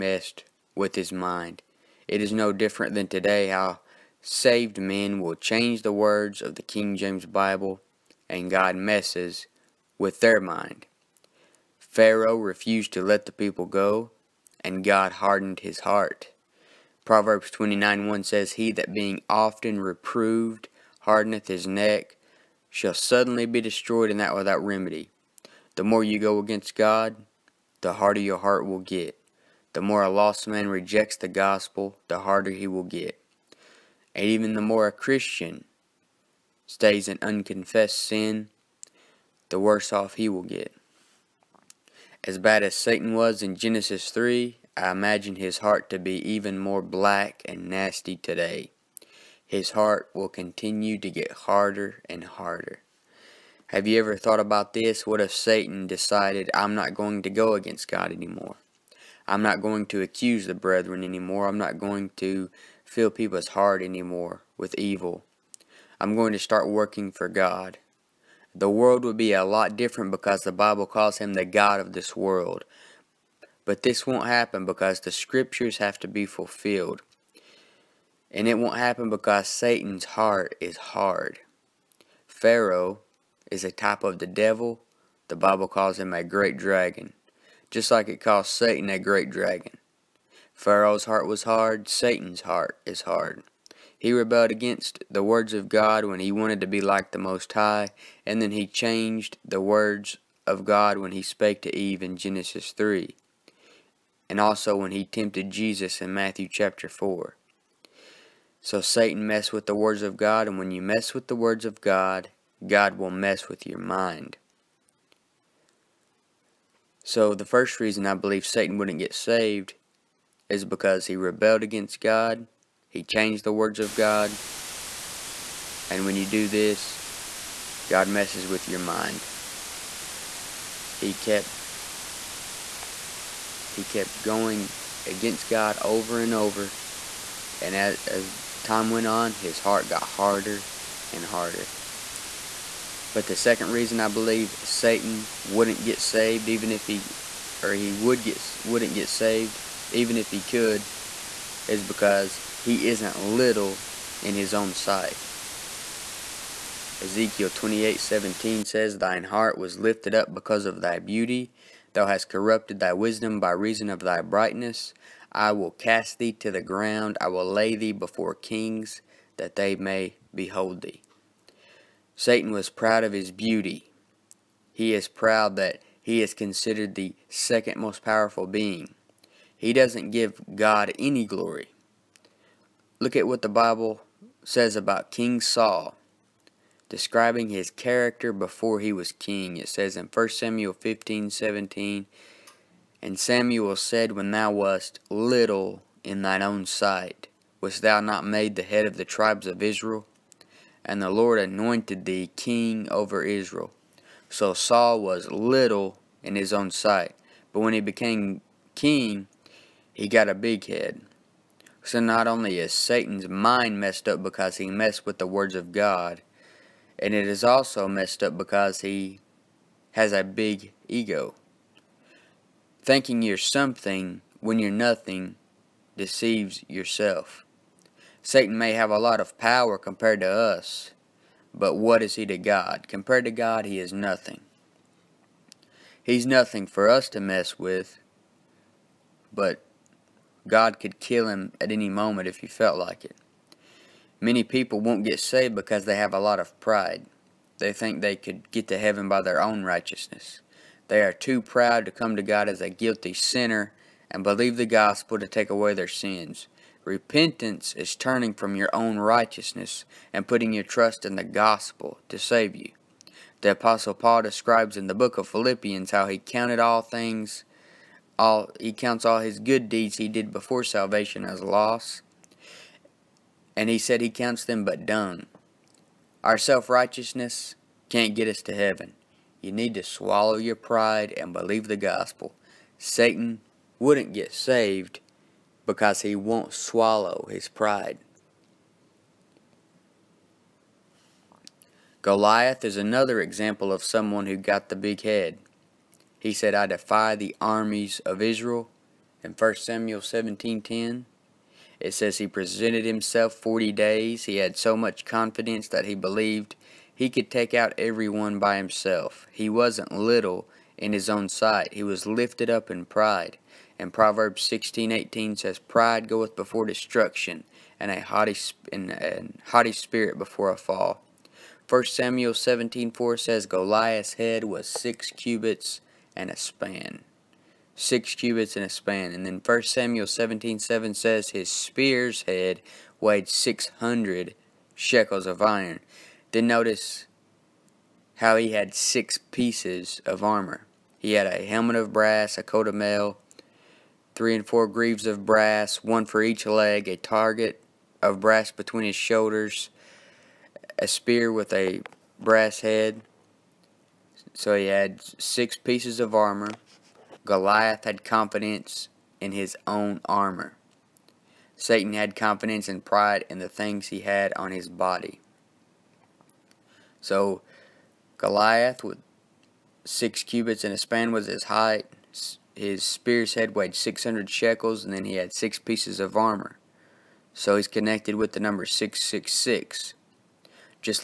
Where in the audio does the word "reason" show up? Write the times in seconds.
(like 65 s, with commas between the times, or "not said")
117 s, 143 s, 163 s.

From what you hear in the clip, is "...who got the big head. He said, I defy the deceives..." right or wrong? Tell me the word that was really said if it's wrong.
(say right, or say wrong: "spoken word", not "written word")
wrong: "armies", not "deceives".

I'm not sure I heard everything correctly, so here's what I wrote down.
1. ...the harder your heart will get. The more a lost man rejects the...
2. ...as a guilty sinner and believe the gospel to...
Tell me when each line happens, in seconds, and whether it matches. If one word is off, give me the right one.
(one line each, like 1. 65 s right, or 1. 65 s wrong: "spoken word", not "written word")
1. 27 s right
2. 252 s right.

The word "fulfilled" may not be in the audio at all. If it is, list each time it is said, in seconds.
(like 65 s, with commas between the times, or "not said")
76 s.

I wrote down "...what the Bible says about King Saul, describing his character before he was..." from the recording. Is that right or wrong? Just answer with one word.
right.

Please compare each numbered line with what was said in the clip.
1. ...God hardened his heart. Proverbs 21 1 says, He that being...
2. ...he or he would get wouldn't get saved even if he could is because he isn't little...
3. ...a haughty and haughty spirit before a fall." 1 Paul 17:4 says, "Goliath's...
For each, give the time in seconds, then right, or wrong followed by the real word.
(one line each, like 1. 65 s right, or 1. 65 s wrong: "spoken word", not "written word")
1. 14 s wrong: "29", not "21"
2. 146 s right
3. 317 s wrong: "Samuel", not "Paul".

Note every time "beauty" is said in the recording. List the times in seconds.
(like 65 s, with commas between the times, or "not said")
160 s, 173 s.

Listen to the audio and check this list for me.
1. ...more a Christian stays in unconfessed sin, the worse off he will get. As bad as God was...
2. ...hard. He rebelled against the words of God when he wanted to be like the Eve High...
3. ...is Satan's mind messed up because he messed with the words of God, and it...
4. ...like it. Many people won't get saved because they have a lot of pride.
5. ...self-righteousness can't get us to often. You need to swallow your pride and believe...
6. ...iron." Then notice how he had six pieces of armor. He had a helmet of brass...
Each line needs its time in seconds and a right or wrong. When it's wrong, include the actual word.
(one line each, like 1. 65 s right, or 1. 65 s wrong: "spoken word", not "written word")
1. 34 s wrong: "Satan", not "God"
2. 93 s wrong: "Most", not "Eve"
3. 212 s right
4. 242 s right
5. 276 s wrong: "heaven", not "often"
6. 335 s right.